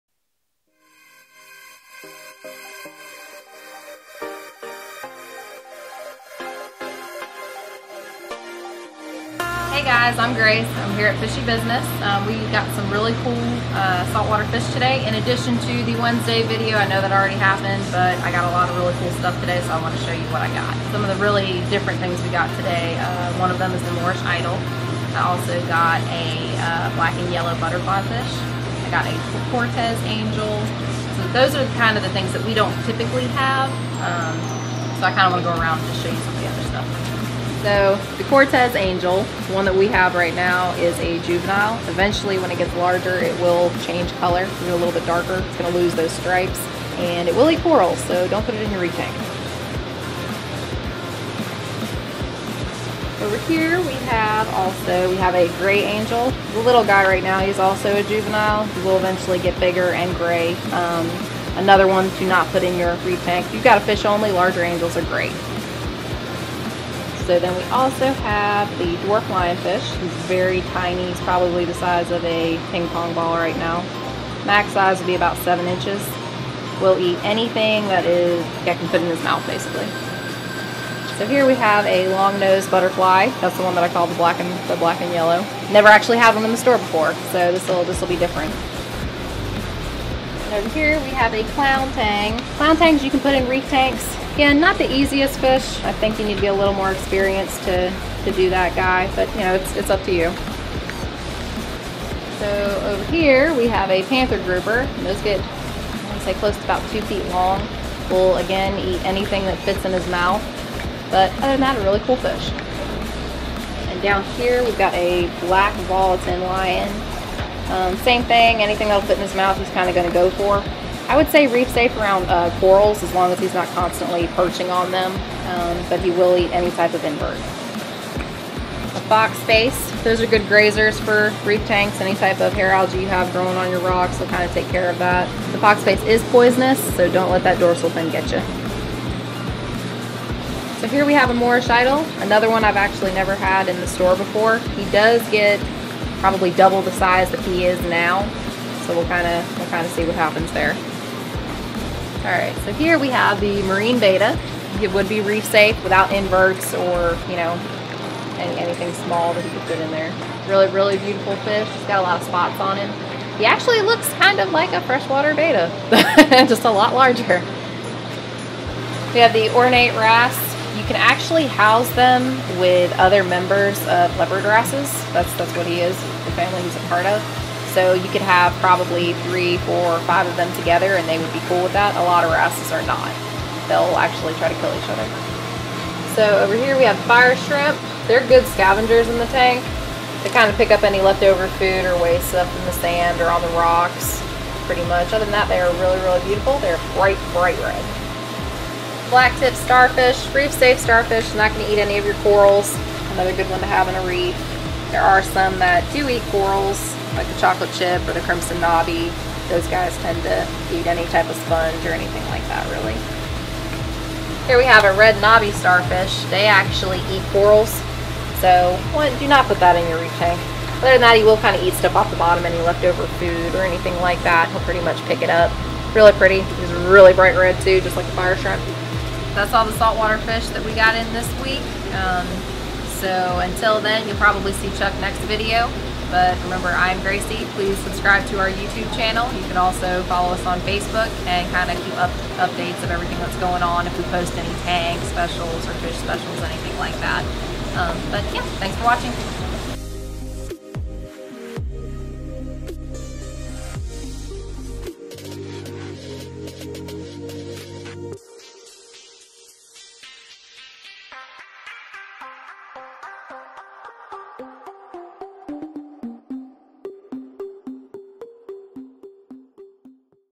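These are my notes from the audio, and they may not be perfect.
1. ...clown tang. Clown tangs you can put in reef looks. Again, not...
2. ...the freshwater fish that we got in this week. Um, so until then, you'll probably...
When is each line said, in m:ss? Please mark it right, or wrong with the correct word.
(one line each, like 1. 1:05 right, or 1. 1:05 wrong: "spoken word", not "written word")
1. 1:31 wrong: "tanks", not "looks"
2. 3:49 wrong: "saltwater", not "freshwater".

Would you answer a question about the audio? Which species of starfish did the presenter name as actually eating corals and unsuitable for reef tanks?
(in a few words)
Red knobby starfish.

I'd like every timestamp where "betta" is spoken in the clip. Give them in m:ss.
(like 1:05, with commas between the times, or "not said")
2:33, 2:45.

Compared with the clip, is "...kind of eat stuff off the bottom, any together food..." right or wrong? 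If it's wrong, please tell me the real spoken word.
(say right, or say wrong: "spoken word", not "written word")
wrong: "leftover", not "together".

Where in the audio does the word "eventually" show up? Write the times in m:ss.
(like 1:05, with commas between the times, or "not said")
0:41, 0:58.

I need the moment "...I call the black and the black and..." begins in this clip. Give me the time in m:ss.
1:23.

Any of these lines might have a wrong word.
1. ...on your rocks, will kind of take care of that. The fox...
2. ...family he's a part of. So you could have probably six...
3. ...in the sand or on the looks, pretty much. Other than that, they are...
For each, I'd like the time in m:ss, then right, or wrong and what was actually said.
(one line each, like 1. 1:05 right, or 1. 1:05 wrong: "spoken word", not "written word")
1. 2:13 right
2. 2:56 wrong: "three", not "six"
3. 3:12 wrong: "rocks", not "looks".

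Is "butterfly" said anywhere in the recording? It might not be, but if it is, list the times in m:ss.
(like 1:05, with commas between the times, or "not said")
0:27, 1:22.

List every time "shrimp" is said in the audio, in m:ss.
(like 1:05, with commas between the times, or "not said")
3:07, 3:48.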